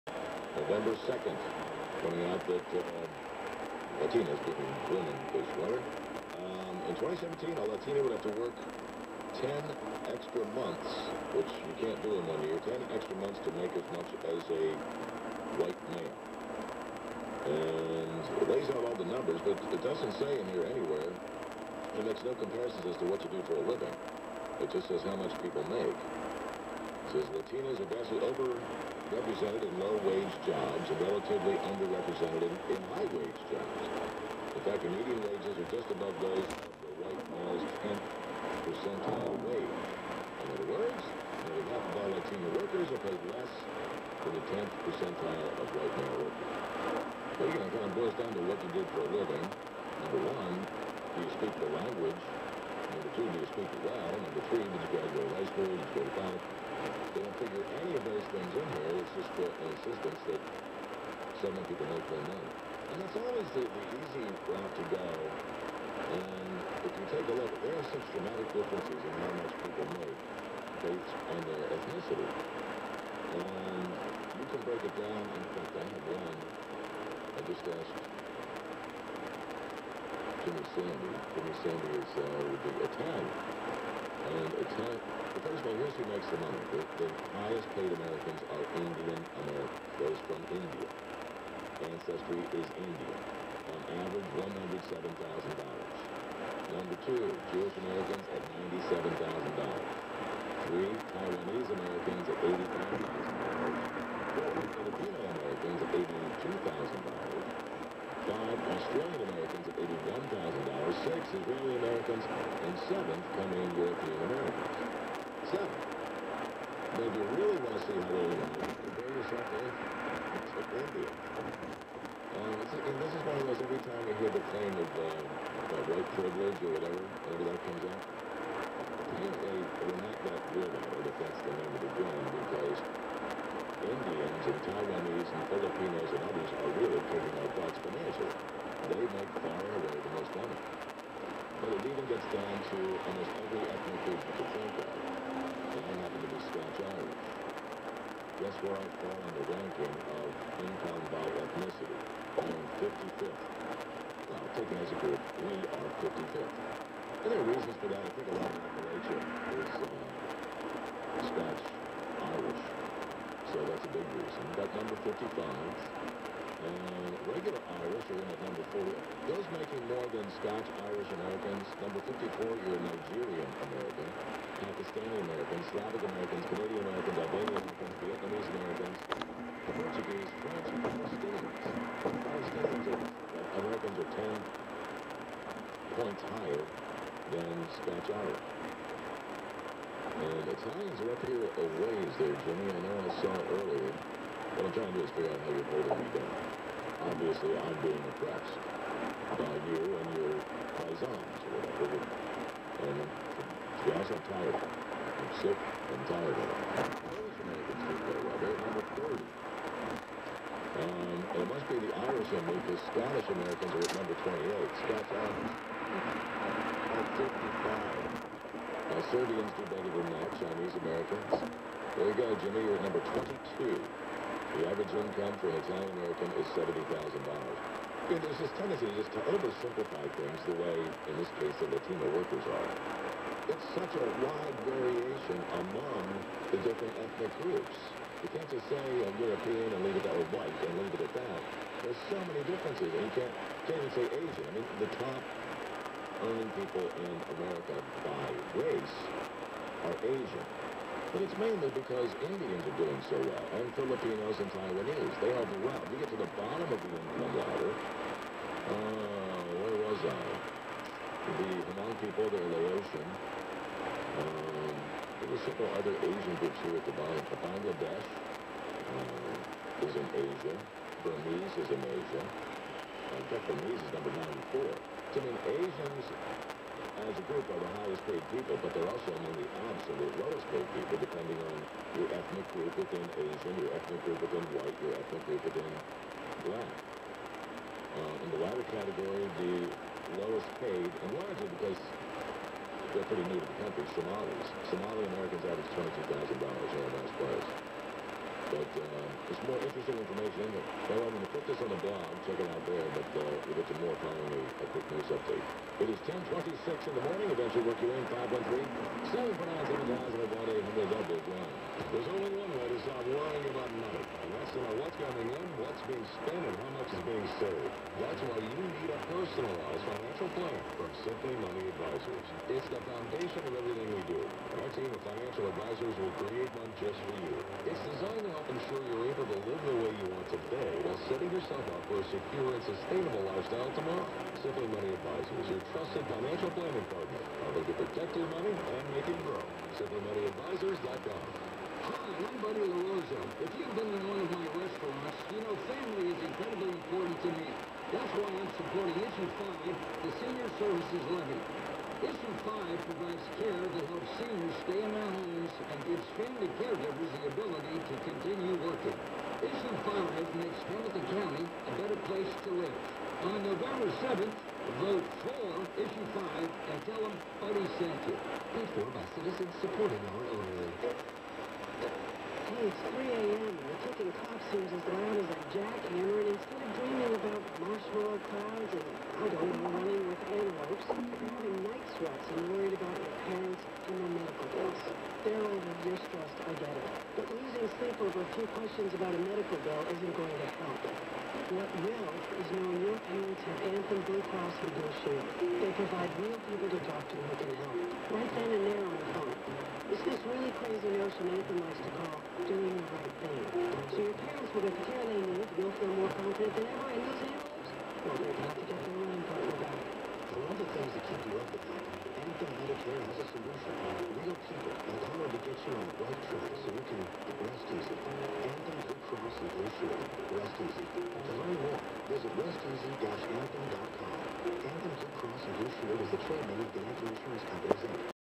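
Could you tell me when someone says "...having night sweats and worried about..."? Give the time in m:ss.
6:21.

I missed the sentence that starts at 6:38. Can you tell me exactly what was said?
Right then and there on the phone.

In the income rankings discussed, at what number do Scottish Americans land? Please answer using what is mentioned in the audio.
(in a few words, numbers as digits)
28.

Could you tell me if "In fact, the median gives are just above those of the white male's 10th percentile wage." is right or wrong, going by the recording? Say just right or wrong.
wrong.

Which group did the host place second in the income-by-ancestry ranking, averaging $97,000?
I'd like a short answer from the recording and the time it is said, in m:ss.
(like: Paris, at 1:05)
Jewish Americans, at 1:37.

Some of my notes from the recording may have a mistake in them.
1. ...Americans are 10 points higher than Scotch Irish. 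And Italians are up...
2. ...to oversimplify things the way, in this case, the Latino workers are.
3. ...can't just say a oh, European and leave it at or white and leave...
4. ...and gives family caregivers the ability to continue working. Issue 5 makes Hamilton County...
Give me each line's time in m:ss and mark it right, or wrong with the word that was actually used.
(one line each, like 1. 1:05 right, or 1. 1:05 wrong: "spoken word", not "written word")
1. 3:03 right
2. 3:49 right
3. 3:58 right
4. 5:55 right.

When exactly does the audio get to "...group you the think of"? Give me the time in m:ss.
2:24.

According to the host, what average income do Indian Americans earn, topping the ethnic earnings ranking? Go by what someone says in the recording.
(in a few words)
$107,000.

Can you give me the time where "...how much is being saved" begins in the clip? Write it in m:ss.
5:16.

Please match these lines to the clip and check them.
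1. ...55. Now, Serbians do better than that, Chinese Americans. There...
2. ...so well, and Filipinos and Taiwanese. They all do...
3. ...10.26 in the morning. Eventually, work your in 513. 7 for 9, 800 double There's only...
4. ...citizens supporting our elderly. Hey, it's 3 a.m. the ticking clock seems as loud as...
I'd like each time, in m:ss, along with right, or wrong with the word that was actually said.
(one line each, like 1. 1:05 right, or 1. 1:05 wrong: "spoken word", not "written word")
1. 3:37 right
2. 4:13 right
3. 5:06 right
4. 6:09 right.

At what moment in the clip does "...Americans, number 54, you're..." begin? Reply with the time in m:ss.
2:51.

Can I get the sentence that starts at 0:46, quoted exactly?
Well, you know, it kind of boils down to what you did for a living.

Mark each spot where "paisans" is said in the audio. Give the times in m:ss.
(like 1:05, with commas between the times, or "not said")
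3:20.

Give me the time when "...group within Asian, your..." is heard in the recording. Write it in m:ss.
4:42.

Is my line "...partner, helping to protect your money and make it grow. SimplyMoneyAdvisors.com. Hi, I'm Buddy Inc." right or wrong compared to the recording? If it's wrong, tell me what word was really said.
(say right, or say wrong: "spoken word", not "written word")
wrong: "LaRosa", not "Inc".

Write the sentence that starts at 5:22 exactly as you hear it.
It's the foundation of everything we do, and our team of financial advisors will create one just for you.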